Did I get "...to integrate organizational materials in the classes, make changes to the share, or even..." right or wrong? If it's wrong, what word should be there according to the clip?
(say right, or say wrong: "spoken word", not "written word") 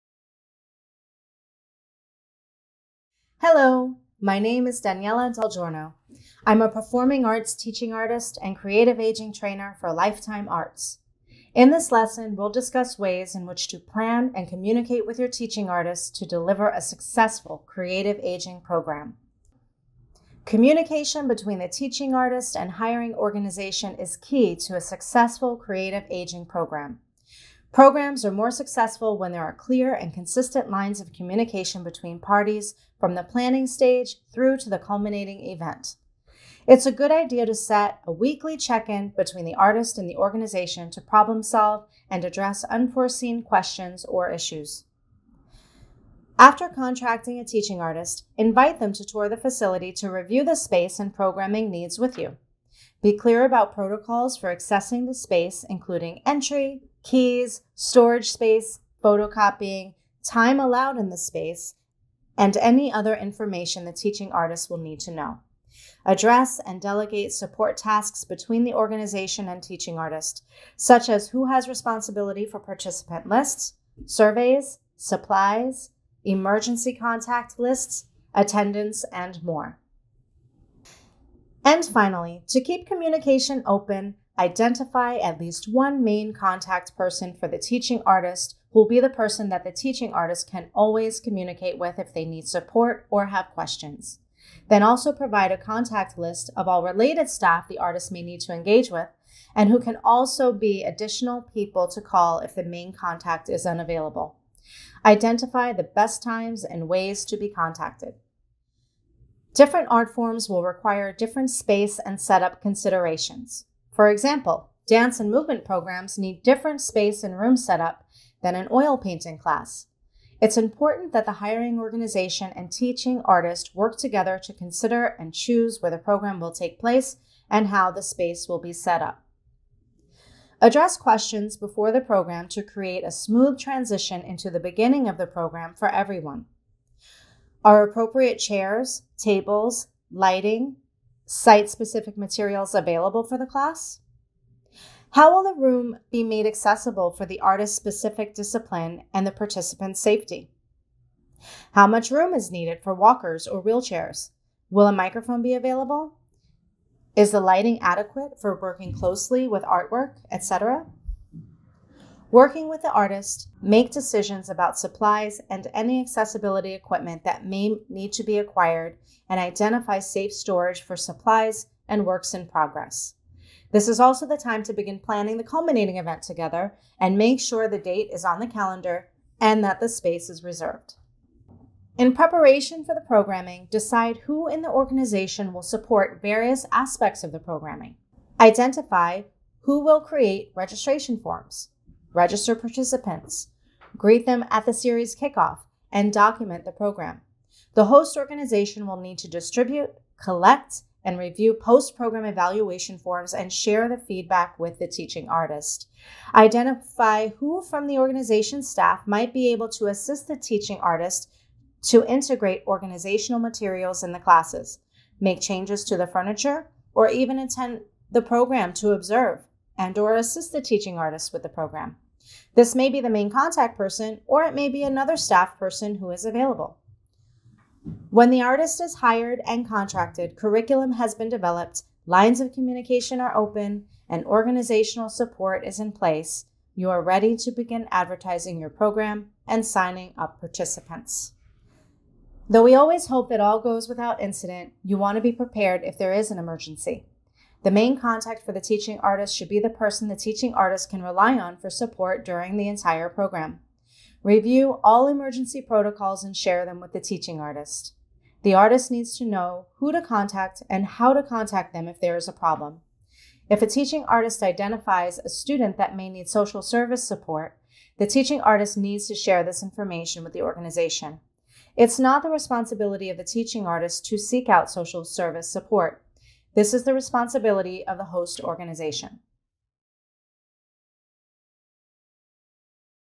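wrong: "furniture", not "share".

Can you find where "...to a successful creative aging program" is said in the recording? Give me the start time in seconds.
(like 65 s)
24 s.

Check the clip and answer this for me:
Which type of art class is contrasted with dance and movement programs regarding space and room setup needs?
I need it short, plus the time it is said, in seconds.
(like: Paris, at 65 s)
Oil painting, at 118 s.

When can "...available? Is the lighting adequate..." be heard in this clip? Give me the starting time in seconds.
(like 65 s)
155 s.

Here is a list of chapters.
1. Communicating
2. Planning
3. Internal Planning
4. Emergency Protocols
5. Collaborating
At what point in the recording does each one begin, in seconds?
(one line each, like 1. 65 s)
1. 18 s
2. 81 s
3. 182 s
4. 242 s
5. 115 s.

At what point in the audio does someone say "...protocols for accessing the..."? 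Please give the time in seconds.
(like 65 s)
53 s.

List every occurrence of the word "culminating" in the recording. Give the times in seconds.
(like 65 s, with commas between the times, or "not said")
34 s, 175 s.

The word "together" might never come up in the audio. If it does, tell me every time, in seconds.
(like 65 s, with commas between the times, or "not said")
123 s, 176 s.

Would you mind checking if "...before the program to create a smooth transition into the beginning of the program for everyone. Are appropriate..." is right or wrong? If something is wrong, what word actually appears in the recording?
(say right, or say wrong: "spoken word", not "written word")
right.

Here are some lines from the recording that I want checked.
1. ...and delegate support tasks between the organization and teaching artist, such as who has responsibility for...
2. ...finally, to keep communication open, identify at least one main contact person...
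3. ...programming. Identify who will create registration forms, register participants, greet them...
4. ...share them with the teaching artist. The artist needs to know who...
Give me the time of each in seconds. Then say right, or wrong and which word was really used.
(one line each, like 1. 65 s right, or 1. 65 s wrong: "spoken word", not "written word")
1. 66 s right
2. 81 s right
3. 187 s right
4. 256 s right.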